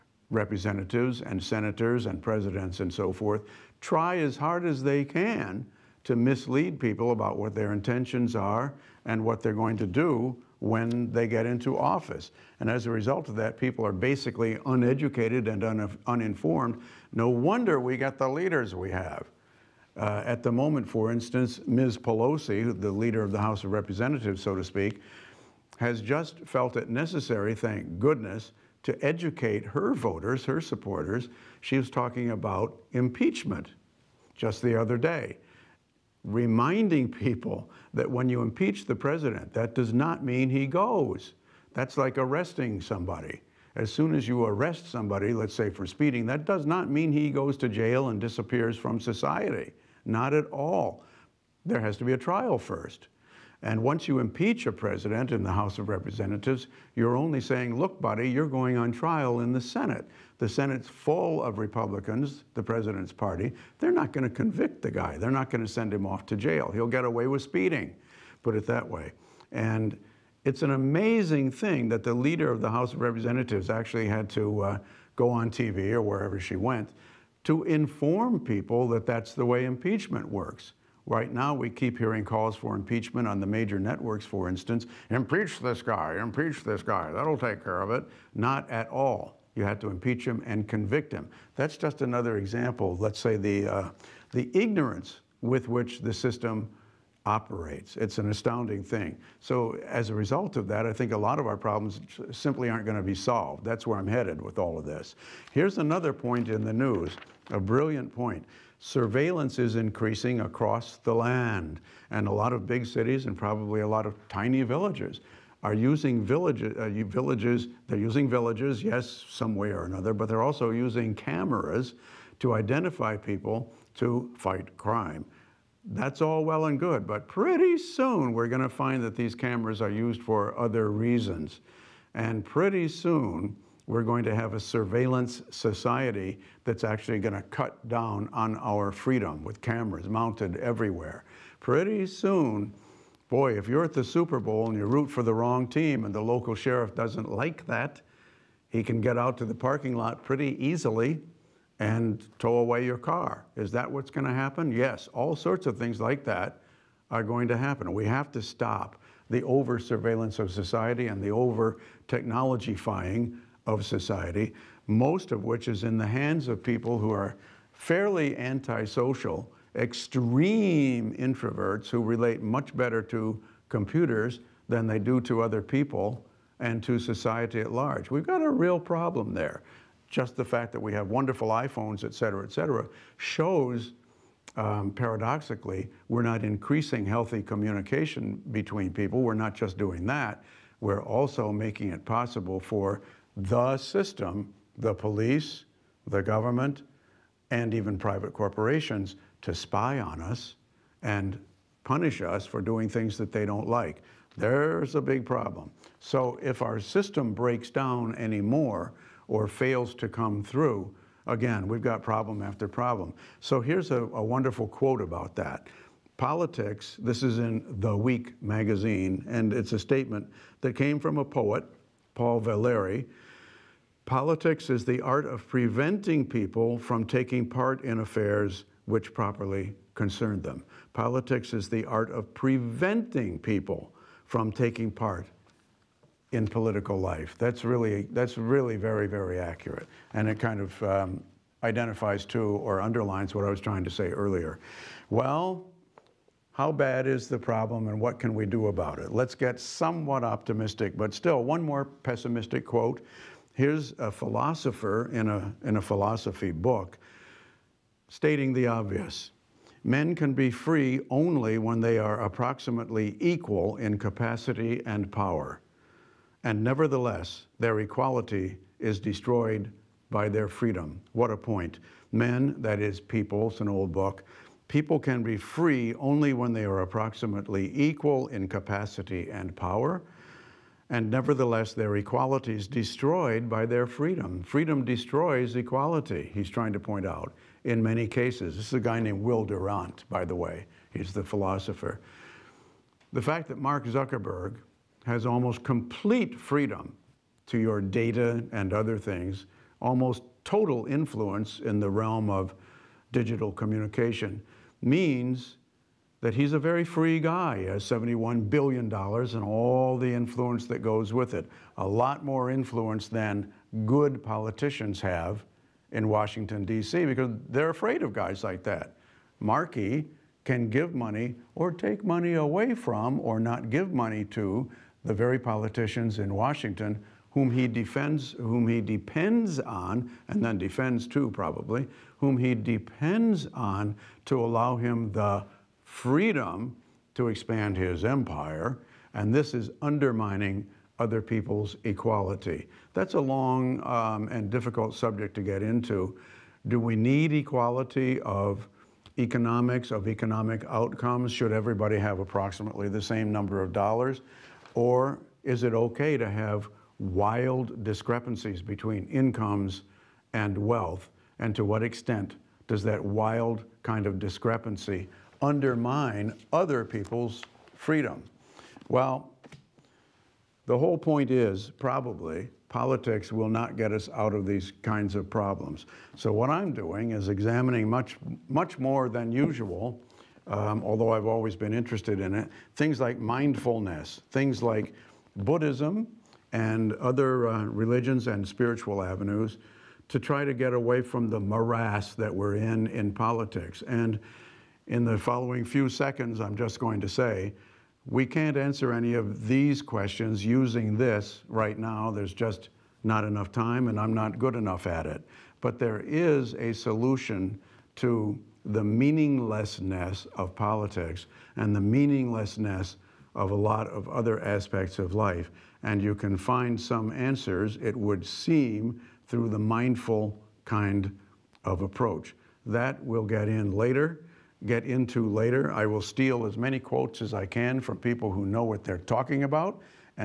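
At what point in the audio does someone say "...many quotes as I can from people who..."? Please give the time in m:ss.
7:06.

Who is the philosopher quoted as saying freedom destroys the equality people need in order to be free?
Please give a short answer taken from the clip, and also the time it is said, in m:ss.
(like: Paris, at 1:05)
Will Durant, at 4:49.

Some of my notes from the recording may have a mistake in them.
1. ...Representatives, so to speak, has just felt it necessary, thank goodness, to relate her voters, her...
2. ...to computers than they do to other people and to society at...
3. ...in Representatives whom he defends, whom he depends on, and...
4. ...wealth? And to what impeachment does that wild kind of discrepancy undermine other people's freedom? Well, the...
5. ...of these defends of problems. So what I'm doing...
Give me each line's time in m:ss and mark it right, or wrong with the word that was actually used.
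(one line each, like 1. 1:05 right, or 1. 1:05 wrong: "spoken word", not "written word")
1. 0:23 wrong: "educate", not "relate"
2. 2:53 right
3. 5:26 wrong: "Washington", not "Representatives"
4. 6:00 wrong: "extent", not "impeachment"
5. 6:14 wrong: "kinds", not "defends".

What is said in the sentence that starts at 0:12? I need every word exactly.
And as a result of that, people are basically uneducated and un uninformed.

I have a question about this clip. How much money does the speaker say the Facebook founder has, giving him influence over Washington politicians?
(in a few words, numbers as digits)
$71 billion.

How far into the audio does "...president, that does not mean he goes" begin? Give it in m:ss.
0:38.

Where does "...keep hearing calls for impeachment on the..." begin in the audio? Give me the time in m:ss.
1:21.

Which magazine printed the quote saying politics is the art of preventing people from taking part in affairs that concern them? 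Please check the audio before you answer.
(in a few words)
The Week.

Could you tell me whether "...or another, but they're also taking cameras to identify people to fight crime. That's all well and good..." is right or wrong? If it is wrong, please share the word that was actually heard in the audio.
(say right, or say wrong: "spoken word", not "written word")
wrong: "using", not "taking".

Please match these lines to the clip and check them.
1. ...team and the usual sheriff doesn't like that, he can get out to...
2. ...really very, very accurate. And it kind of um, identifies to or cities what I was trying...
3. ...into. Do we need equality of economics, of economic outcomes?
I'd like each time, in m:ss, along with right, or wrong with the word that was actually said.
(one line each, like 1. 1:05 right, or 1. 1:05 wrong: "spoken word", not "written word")
1. 2:25 wrong: "local", not "usual"
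2. 3:58 wrong: "underlines", not "cities"
3. 5:45 right.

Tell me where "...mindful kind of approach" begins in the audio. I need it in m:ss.
6:59.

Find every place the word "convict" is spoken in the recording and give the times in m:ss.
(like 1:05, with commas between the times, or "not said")
1:04, 1:30.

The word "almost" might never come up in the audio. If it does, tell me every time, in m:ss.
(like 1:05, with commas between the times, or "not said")
4:55, 4:59.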